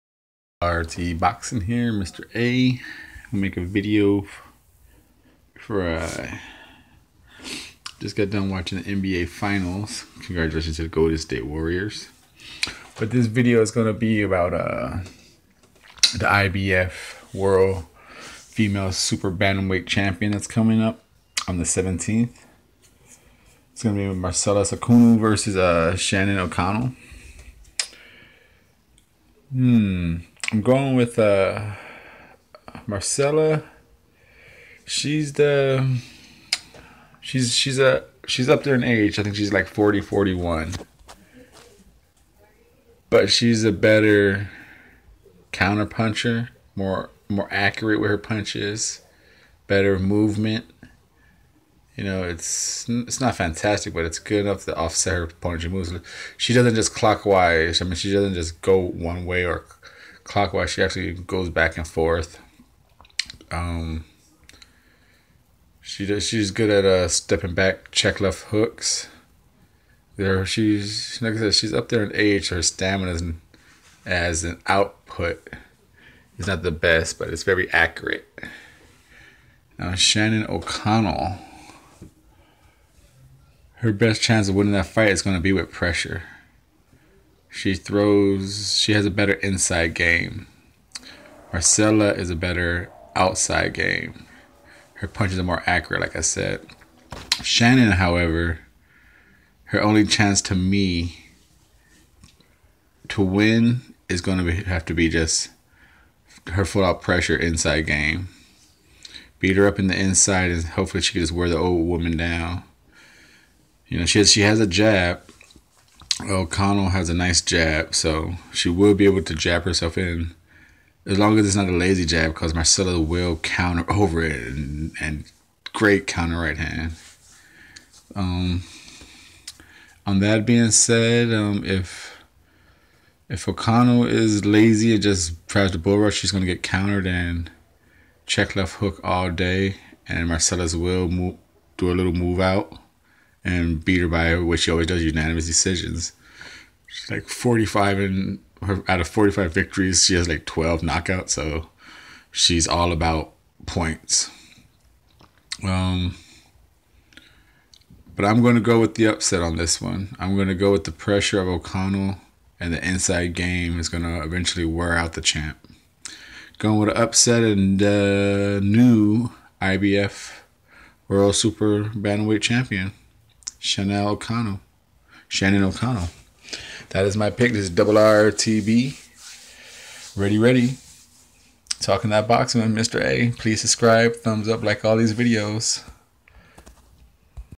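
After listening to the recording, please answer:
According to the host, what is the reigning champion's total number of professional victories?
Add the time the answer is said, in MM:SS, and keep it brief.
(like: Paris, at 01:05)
45, at 02:29.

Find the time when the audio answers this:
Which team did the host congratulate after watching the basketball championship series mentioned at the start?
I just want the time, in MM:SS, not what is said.
00:10.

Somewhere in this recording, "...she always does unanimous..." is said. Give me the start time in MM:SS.
02:24.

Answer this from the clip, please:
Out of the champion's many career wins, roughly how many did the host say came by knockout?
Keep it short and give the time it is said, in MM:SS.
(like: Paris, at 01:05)
12, at 02:30.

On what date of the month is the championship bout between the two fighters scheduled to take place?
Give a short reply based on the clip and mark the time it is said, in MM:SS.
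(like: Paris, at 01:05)
17th, at 00:21.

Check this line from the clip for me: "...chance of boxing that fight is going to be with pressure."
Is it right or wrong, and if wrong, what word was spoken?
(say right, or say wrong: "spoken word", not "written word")
wrong: "winning", not "boxing".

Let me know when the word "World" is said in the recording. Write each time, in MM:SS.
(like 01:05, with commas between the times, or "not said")
00:17, 02:51.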